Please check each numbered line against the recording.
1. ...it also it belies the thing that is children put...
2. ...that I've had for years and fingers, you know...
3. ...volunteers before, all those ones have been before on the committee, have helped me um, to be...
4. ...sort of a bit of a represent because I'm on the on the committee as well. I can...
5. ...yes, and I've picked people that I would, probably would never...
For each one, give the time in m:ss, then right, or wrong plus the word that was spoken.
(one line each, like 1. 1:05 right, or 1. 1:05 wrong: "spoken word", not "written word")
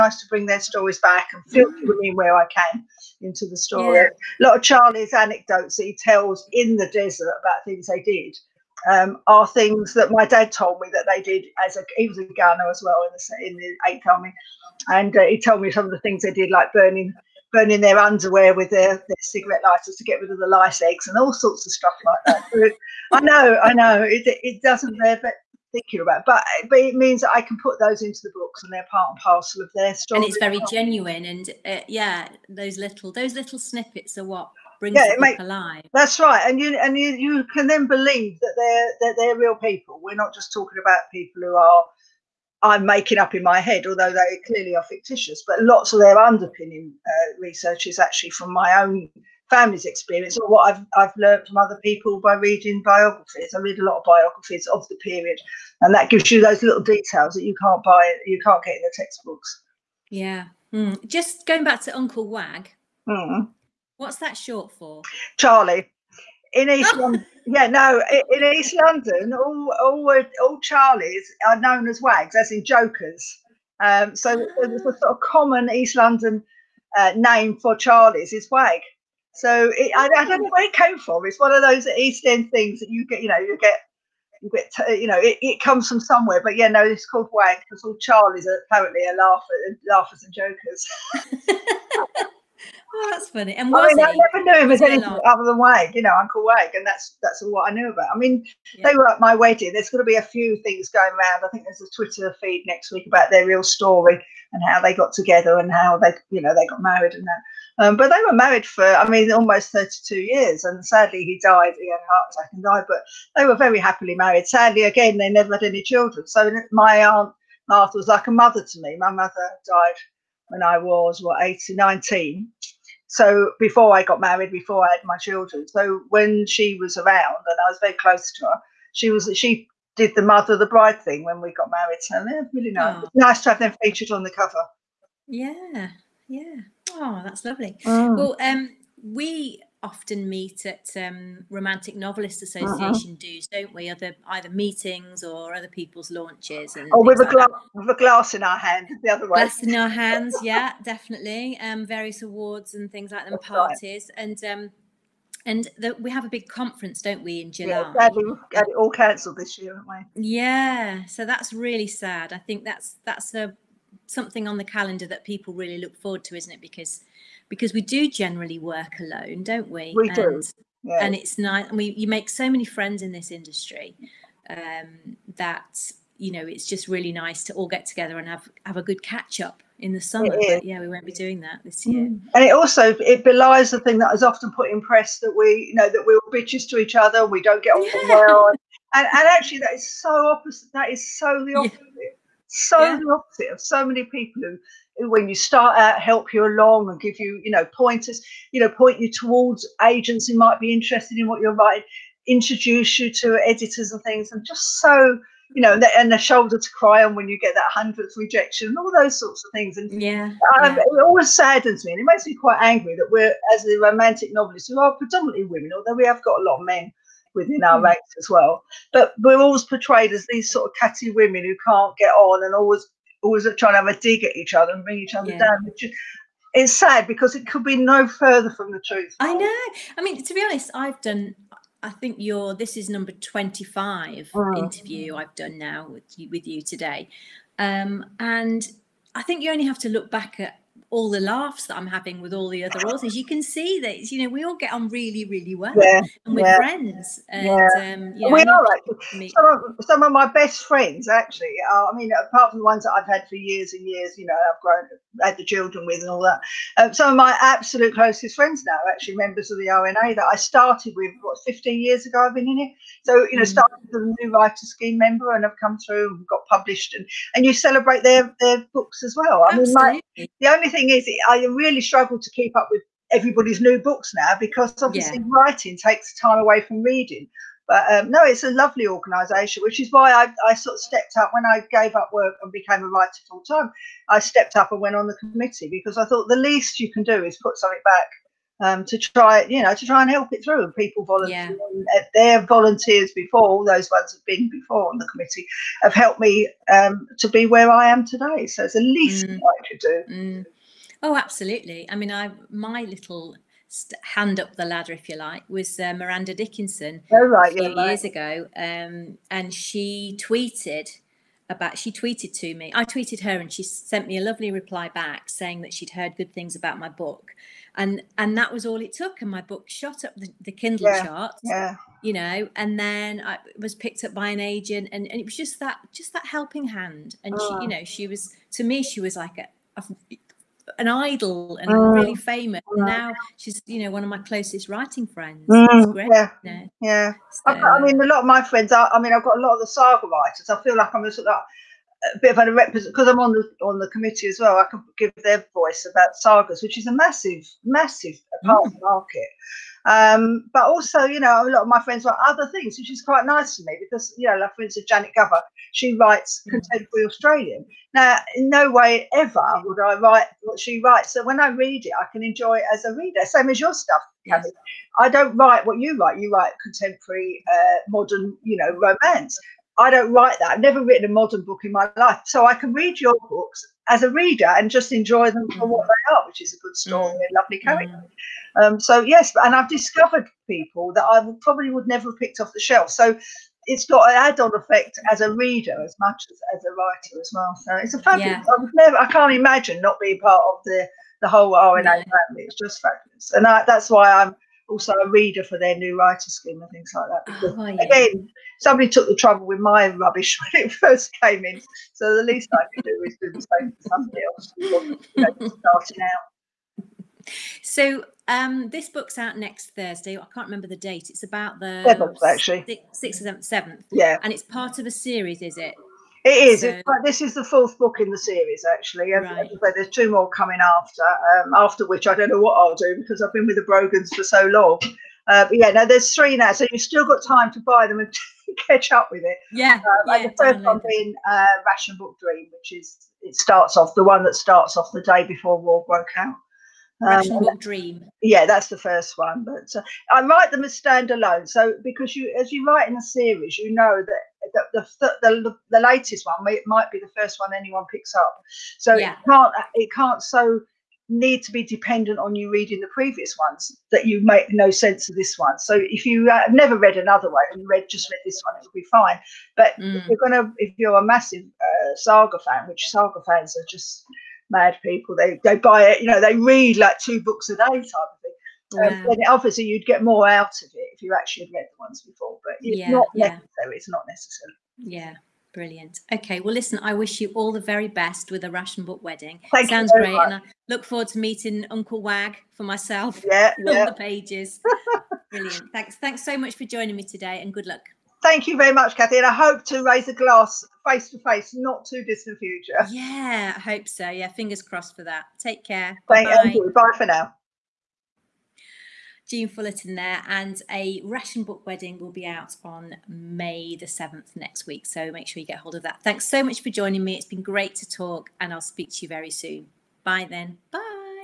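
1. 3:02 wrong: "often", not "children"
2. 4:12 wrong: "years", not "fingers"
3. 4:52 right
4. 5:41 right
5. 6:19 wrong: "discovered", not "picked".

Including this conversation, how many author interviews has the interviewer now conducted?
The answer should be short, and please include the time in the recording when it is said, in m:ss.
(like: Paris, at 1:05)
25, at 3:53.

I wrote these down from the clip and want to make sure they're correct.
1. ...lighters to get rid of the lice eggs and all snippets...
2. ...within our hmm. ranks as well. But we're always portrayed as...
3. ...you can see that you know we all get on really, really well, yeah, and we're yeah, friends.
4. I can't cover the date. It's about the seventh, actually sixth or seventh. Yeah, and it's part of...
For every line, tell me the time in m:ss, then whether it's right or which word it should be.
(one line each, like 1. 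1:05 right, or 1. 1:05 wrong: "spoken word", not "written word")
1. 0:19 wrong: "sorts", not "snippets"
2. 3:37 right
3. 4:03 right
4. 6:50 wrong: "remember", not "cover".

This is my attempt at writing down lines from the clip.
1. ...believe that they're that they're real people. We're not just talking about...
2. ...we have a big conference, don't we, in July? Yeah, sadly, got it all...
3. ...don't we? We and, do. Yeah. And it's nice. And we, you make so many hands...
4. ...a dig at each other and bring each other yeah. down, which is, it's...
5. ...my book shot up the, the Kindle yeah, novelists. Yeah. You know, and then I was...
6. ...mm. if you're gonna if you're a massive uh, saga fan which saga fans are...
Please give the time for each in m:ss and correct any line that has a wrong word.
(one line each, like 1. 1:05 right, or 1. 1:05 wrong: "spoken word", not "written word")
1. 0:37 right
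2. 2:35 right
3. 2:49 wrong: "friends", not "hands"
4. 3:43 right
5. 5:19 wrong: "charts", not "novelists"
6. 7:39 right.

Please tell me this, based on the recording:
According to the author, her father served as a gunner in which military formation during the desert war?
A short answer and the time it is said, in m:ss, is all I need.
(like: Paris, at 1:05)
Eighth Army, at 0:13.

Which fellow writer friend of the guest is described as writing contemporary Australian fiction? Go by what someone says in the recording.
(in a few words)
Janet Gover.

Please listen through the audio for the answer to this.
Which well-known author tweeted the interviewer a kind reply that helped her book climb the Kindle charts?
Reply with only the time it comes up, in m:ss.
5:05.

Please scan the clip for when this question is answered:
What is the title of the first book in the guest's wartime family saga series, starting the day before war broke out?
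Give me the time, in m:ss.
7:11.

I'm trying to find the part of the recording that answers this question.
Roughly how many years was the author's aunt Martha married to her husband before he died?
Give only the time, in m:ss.
1:49.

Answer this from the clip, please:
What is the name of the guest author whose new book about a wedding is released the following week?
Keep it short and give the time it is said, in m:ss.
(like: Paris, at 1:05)
Jean Fullerton, at 8:19.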